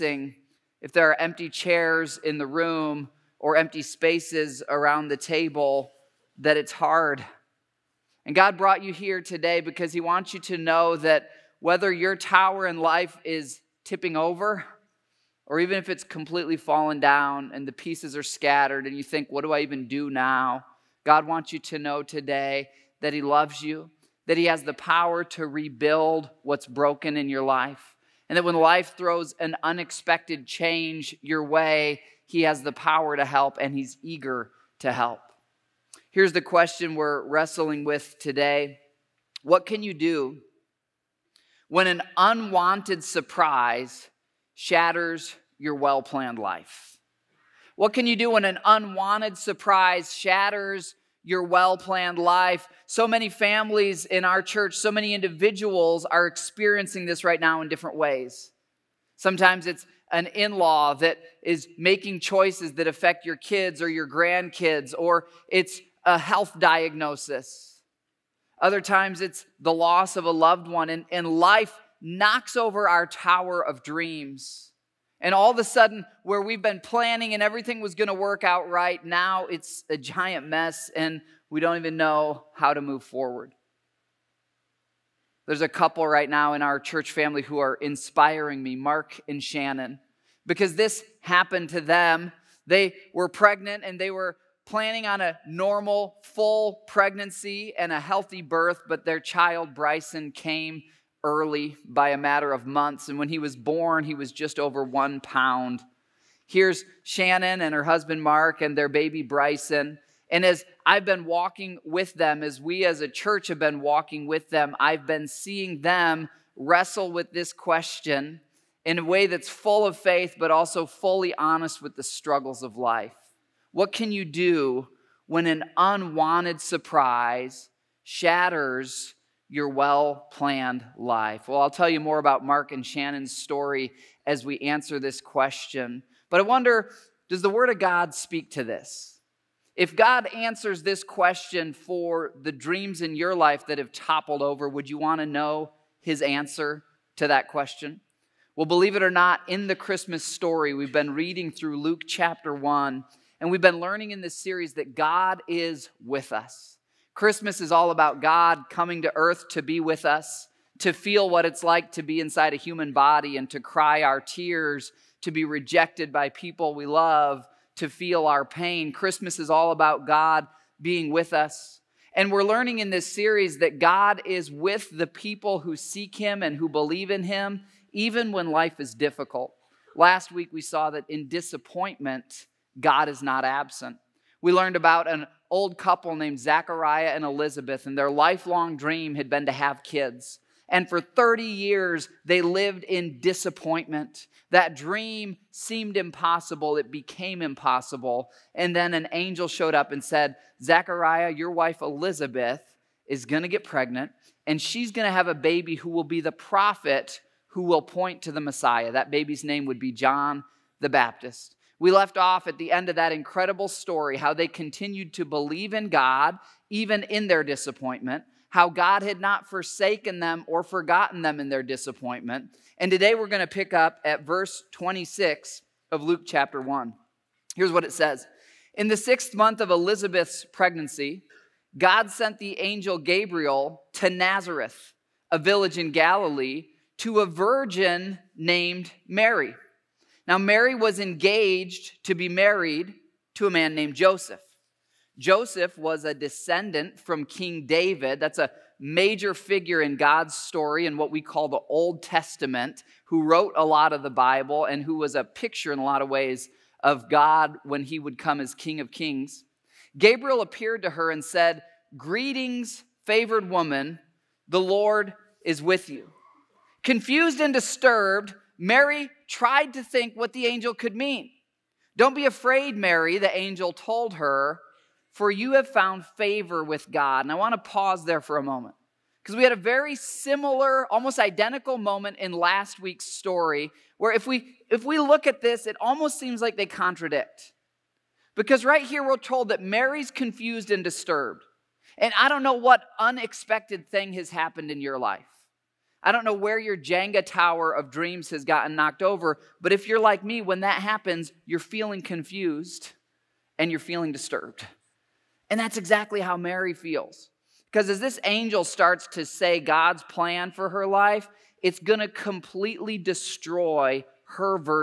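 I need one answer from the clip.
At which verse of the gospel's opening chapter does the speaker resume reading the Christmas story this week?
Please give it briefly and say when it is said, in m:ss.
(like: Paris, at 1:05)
Verse 26, at 3:44.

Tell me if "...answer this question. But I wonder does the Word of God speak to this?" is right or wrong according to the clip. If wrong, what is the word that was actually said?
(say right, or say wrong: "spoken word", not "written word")
right.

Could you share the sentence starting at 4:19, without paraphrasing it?
Gabriel appeared to her and said, Greetings, favored woman, the Lord is with you.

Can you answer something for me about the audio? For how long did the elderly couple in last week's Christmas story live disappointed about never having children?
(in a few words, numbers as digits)
30 years.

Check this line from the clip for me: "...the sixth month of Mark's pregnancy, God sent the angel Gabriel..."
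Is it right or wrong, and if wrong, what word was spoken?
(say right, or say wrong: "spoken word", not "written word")
wrong: "Elizabeth", not "Mark".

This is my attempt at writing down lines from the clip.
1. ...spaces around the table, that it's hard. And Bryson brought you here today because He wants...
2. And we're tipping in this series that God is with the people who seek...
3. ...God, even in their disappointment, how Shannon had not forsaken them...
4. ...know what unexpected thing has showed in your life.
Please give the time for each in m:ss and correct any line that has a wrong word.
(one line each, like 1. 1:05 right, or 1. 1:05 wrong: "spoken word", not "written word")
1. 0:03 wrong: "God", not "Bryson"
2. 2:52 wrong: "learning", not "tipping"
3. 3:35 wrong: "God", not "Shannon"
4. 4:52 wrong: "happened", not "showed".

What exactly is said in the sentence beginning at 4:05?
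Joseph was a descendant from King David.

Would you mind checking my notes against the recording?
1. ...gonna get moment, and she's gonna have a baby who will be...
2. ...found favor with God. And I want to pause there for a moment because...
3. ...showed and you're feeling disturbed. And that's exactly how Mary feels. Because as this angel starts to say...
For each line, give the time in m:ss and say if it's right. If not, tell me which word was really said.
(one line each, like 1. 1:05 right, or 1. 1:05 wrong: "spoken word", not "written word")
1. 3:23 wrong: "pregnant", not "moment"
2. 4:35 right
3. 5:02 wrong: "confused", not "showed".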